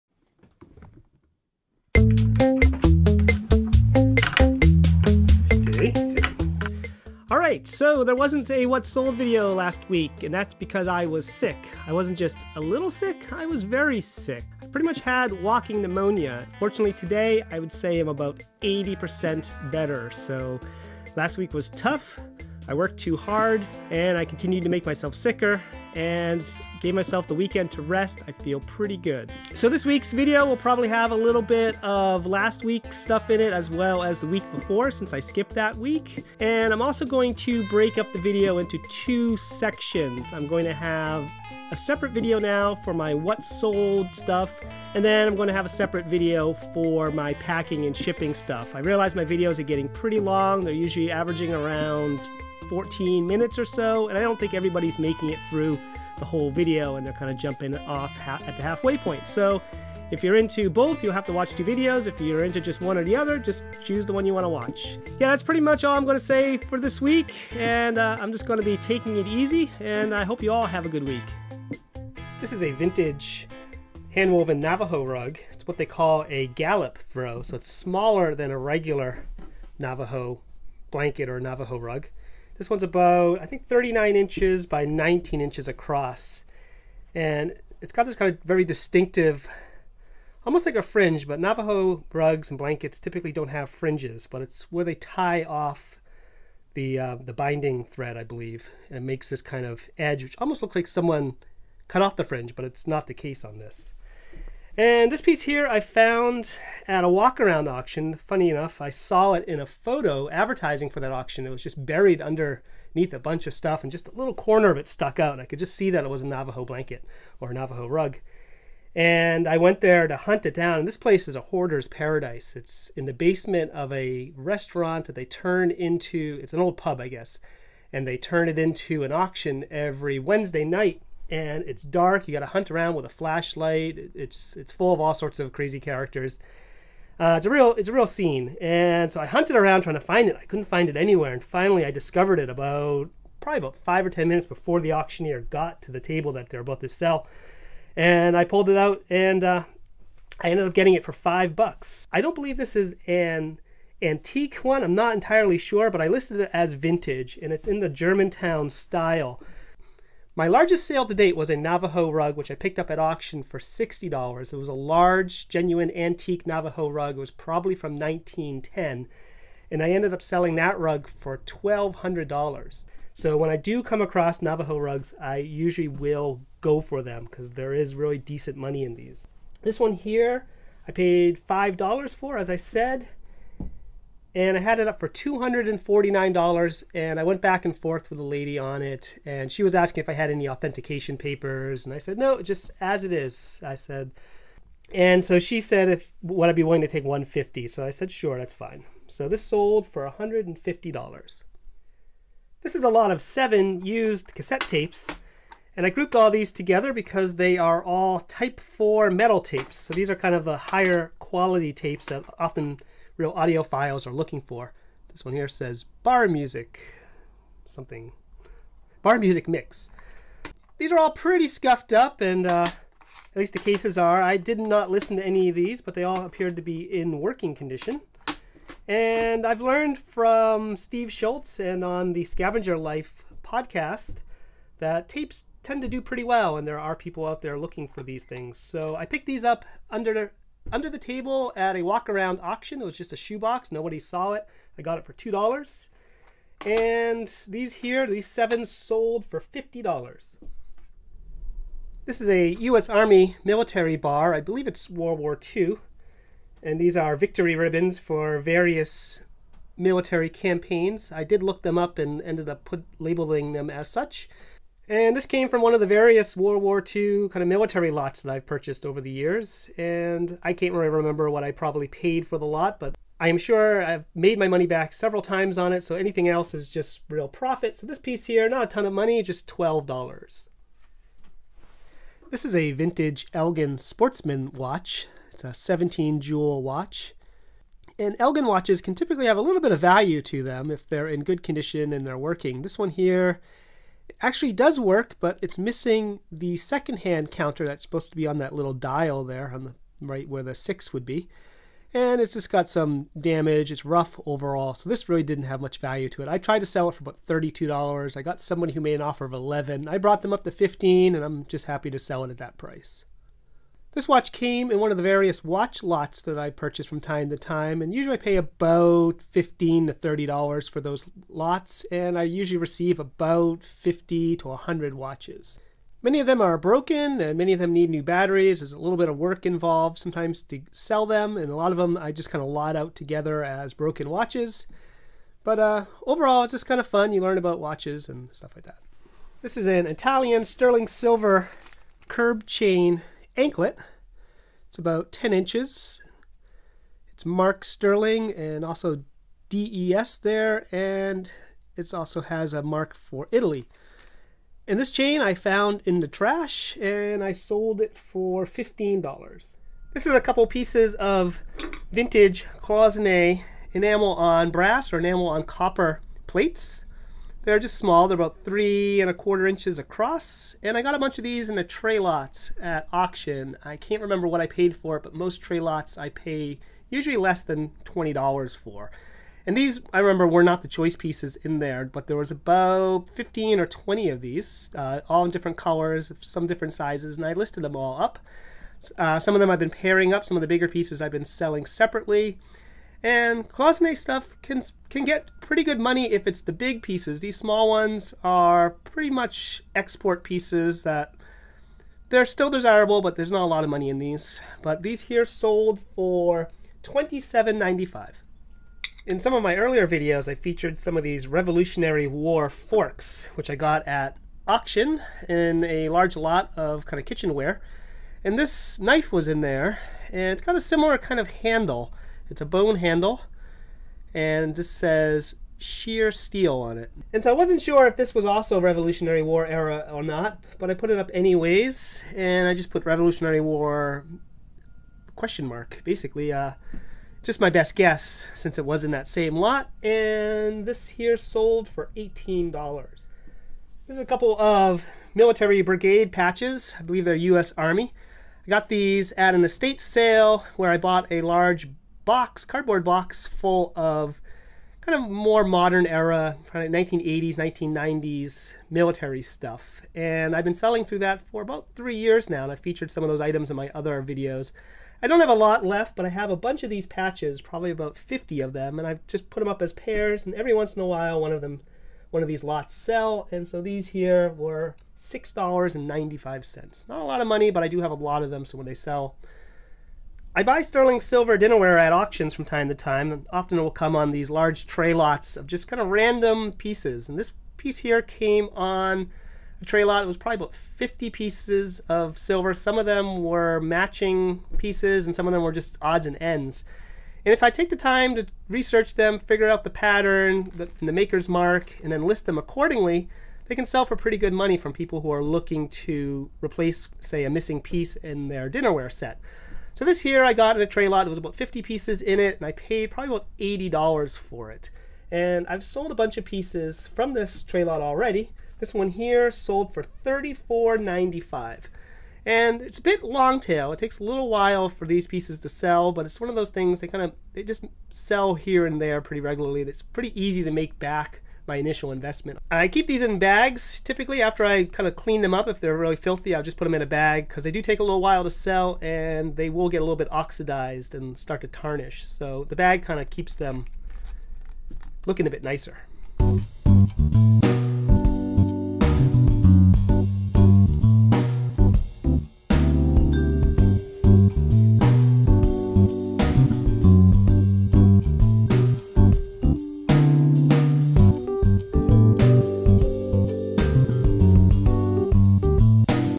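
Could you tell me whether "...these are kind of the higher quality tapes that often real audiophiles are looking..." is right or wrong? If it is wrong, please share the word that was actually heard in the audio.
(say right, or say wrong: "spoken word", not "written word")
right.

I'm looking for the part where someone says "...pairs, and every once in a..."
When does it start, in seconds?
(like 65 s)
469 s.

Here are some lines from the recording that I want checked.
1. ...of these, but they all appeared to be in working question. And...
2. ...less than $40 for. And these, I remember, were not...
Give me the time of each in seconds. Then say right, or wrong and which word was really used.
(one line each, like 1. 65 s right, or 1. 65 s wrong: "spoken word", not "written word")
1. 225 s wrong: "condition", not "question"
2. 377 s wrong: "20", not "40".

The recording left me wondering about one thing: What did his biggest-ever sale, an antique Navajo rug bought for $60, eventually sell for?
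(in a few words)
$1,200.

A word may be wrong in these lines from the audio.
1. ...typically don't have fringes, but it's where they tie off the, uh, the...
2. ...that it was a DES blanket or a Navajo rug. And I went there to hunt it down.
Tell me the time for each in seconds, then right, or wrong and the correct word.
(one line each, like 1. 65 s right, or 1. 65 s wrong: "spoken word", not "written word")
1. 92 s right
2. 115 s wrong: "Navajo", not "DES".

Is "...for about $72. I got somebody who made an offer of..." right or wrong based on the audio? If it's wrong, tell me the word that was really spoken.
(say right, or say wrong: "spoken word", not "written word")
wrong: "32", not "72".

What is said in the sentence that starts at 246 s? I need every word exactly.
And these here, these seven sold for $50.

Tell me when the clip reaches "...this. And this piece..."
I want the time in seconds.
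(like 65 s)
103 s.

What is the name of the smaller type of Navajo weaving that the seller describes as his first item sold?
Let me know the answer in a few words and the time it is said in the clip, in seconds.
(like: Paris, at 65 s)
Gallup throw, at 76 s.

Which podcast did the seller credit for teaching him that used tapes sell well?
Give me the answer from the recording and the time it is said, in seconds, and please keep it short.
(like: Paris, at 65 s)
Scavenger Life, at 232 s.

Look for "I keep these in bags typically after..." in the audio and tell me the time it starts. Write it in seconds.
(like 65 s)
532 s.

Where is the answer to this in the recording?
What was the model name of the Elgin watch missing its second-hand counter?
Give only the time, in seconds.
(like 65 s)
283 s.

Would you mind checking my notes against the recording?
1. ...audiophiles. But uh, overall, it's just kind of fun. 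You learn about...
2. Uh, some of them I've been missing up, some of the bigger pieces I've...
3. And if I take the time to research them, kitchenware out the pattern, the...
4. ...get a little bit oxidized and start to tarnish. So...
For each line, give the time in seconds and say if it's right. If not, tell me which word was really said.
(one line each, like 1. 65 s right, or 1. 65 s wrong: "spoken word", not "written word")
1. 334 s wrong: "watches", not "audiophiles"
2. 388 s wrong: "pairing", not "missing"
3. 497 s wrong: "figure", not "kitchenware"
4. 539 s right.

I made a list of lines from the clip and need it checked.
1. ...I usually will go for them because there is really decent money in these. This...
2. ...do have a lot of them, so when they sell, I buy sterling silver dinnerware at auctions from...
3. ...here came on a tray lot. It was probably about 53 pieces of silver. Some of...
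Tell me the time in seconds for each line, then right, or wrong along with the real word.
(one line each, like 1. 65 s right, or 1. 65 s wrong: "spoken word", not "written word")
1. 175 s right
2. 477 s right
3. 487 s wrong: "50", not "53".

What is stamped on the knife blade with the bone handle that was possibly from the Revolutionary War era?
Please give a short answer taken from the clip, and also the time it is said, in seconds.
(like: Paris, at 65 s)
shear steel, at 425 s.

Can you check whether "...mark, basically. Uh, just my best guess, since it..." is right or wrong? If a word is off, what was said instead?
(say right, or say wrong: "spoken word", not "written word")
right.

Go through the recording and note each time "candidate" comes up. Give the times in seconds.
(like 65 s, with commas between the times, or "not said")
not said.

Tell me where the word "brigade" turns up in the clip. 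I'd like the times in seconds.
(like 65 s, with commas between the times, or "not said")
445 s.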